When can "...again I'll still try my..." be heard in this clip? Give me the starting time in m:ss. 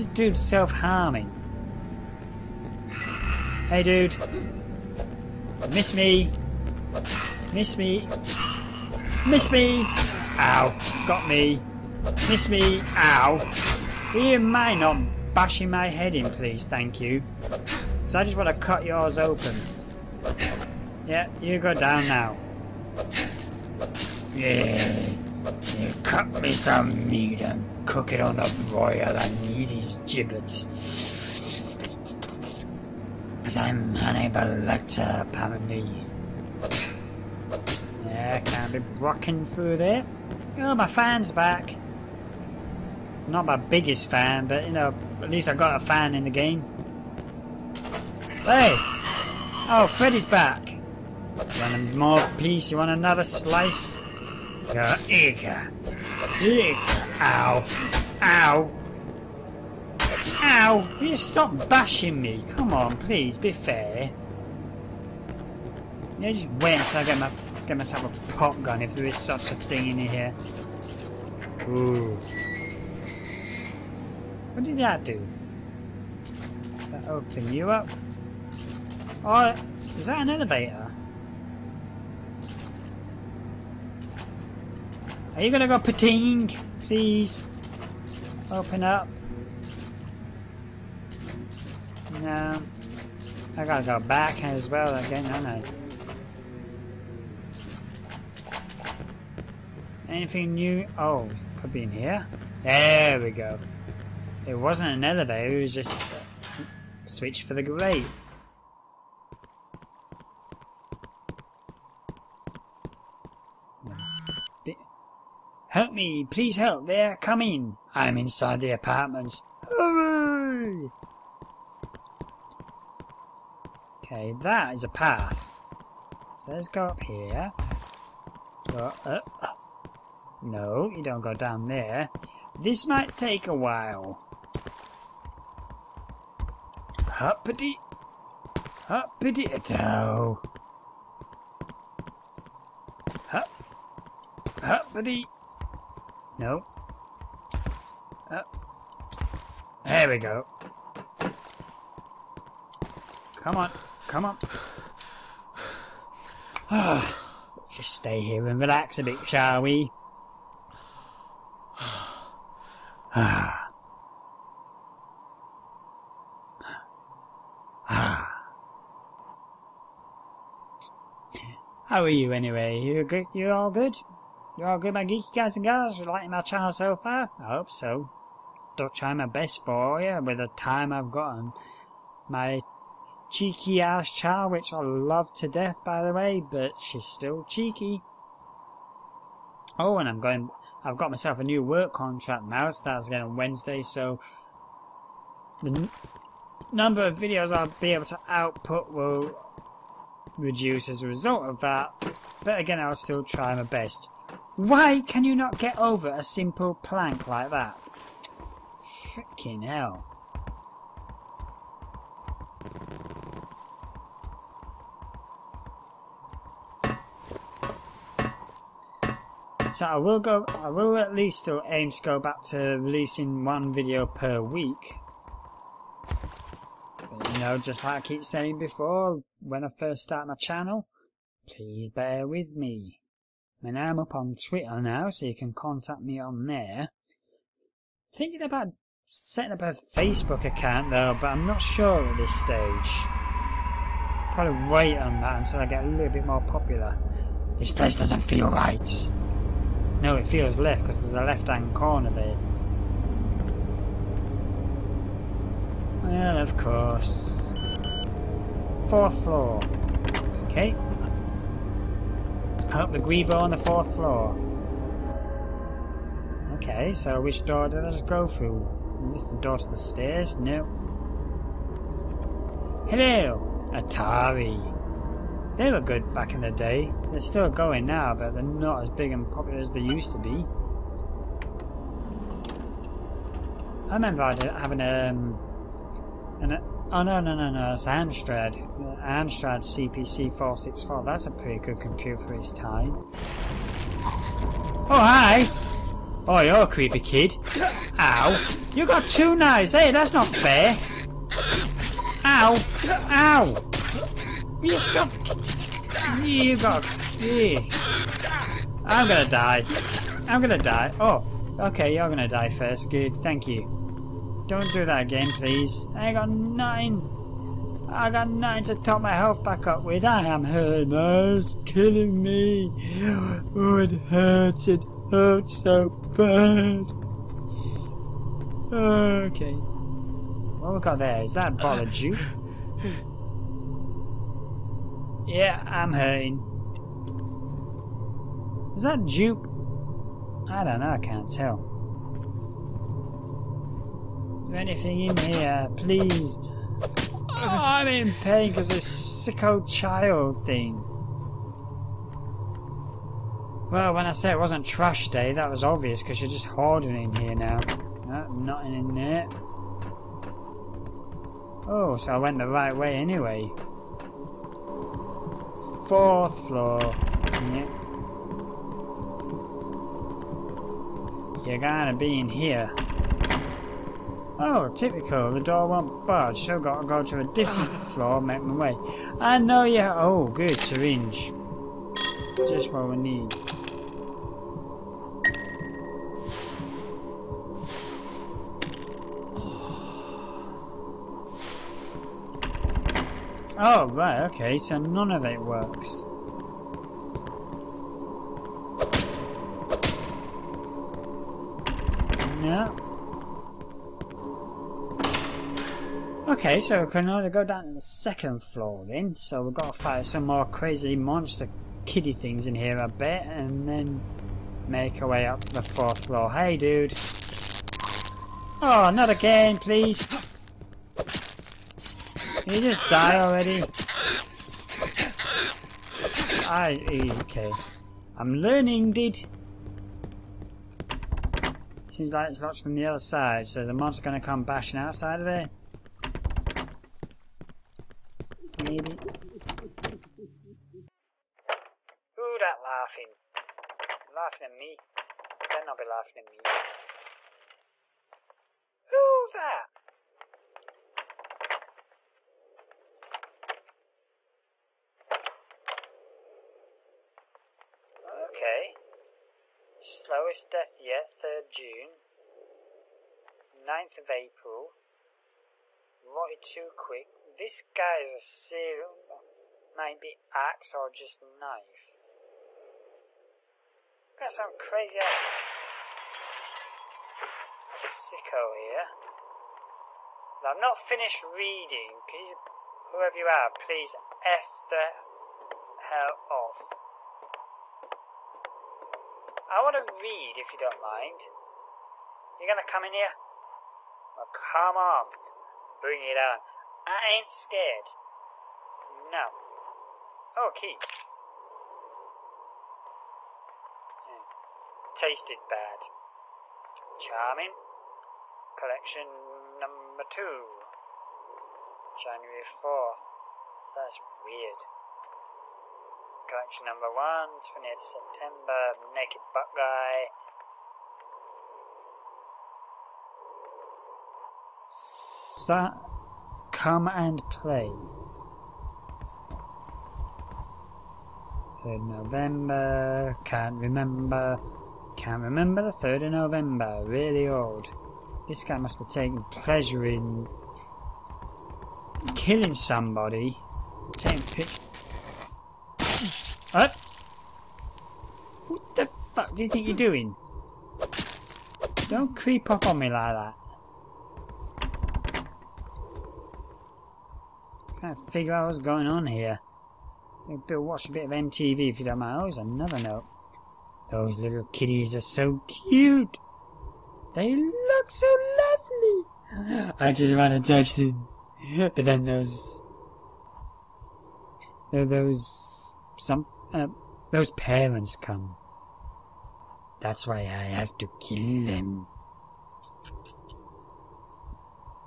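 3:22.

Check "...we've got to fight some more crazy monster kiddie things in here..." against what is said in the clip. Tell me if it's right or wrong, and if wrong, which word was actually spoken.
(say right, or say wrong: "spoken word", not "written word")
right.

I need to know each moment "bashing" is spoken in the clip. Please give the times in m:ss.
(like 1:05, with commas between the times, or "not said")
0:15, 1:01, 7:14.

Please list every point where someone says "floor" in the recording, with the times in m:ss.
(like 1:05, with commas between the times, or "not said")
4:19, 4:23, 6:06, 6:17, 6:48, 6:56.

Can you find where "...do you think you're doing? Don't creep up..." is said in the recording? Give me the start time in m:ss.
9:09.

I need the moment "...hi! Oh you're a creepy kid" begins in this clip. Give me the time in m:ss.
4:54.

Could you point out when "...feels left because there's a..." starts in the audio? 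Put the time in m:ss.
4:10.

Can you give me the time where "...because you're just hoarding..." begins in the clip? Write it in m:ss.
5:56.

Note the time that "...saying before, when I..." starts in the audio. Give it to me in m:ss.
3:48.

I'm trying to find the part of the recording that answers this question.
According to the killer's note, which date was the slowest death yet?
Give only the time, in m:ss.
7:41.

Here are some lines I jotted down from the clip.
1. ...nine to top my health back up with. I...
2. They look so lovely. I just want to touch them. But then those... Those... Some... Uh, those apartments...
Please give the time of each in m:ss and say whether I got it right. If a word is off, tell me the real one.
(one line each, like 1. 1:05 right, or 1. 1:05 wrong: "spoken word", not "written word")
1. 5:18 right
2. 9:27 wrong: "parents", not "apartments".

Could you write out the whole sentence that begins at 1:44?
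It wasn't an elevator, it was just a switch for the grate.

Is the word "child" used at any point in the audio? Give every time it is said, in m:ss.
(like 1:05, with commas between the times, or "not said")
3:04, 5:49.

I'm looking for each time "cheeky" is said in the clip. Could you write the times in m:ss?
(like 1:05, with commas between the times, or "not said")
3:03, 3:07.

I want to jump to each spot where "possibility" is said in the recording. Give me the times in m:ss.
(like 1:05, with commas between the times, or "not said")
not said.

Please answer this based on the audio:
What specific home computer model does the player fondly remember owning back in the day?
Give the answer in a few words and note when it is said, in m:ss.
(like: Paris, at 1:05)
Amstrad CPC 464, at 4:49.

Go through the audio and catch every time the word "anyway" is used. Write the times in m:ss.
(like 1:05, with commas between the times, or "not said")
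2:52, 6:02.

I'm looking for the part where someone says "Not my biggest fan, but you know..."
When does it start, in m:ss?
0:43.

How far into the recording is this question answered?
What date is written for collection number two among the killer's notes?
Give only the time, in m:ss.
8:31.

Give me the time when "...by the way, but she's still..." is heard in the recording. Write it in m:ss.
3:05.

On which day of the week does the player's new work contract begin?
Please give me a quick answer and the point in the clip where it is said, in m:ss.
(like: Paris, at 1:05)
Wednesday, at 3:13.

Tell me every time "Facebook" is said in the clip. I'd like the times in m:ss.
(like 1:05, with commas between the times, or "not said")
3:59.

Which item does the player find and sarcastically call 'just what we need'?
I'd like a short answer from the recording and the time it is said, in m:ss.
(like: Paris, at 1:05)
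Syringe, at 6:20.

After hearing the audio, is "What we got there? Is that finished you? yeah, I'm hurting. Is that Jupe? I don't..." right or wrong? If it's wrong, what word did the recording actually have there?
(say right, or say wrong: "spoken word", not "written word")
wrong: "bothered", not "finished".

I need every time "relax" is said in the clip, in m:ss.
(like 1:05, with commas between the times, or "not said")
2:38.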